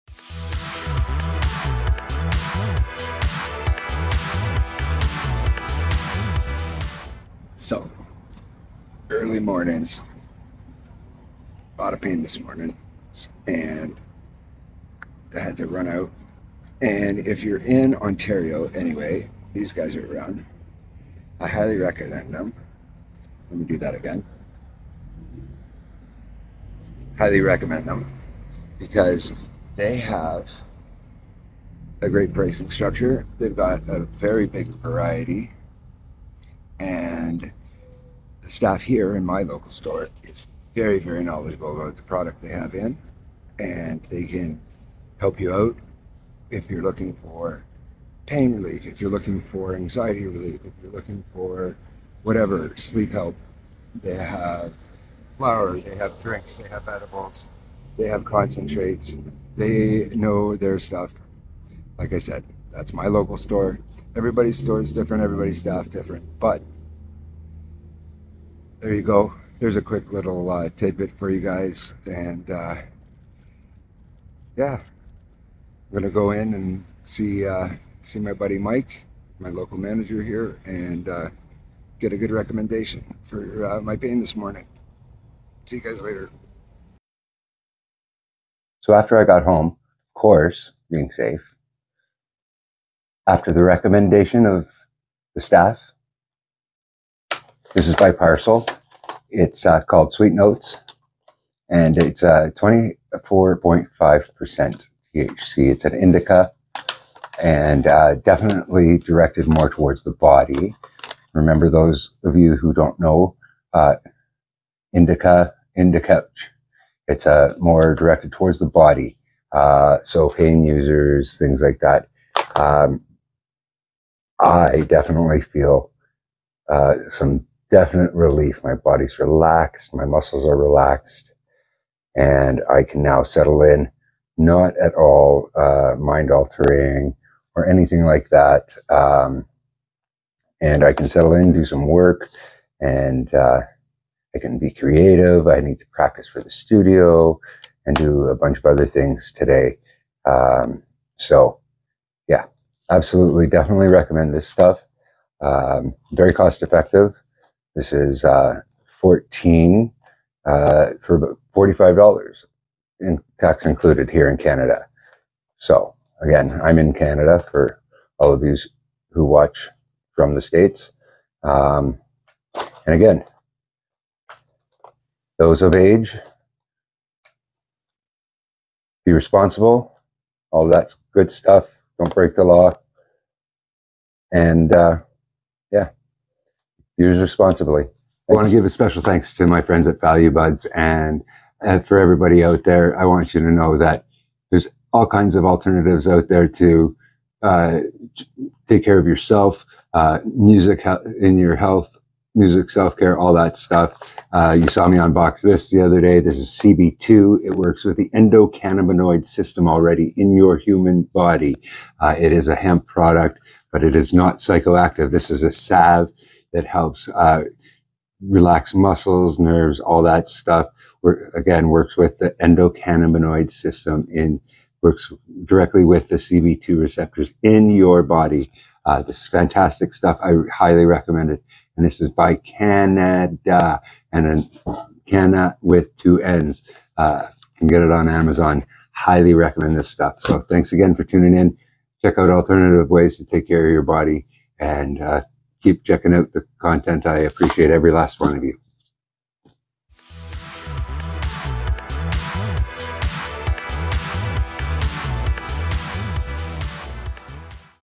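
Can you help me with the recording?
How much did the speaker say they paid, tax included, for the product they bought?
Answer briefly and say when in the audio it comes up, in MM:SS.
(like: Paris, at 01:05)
$45, at 02:41.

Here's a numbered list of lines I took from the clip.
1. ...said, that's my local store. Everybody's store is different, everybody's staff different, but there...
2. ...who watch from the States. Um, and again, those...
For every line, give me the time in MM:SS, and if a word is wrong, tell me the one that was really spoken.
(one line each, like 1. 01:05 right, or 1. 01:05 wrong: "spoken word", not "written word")
1. 01:02 right
2. 02:49 right.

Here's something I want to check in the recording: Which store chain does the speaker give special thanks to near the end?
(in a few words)
Value Buds.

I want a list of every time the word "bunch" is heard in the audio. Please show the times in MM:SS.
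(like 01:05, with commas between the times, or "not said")
02:28.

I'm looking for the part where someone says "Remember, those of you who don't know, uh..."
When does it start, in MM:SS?
01:51.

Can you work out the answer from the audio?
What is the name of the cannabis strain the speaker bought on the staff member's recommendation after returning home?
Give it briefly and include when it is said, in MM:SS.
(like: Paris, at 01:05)
Sweet Notes, at 01:40.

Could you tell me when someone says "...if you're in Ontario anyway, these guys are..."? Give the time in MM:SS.
00:17.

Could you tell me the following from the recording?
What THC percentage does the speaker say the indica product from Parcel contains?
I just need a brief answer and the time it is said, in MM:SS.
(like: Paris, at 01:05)
24.5%, at 01:42.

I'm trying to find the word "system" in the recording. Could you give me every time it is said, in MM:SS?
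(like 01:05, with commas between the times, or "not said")
03:29, 03:43.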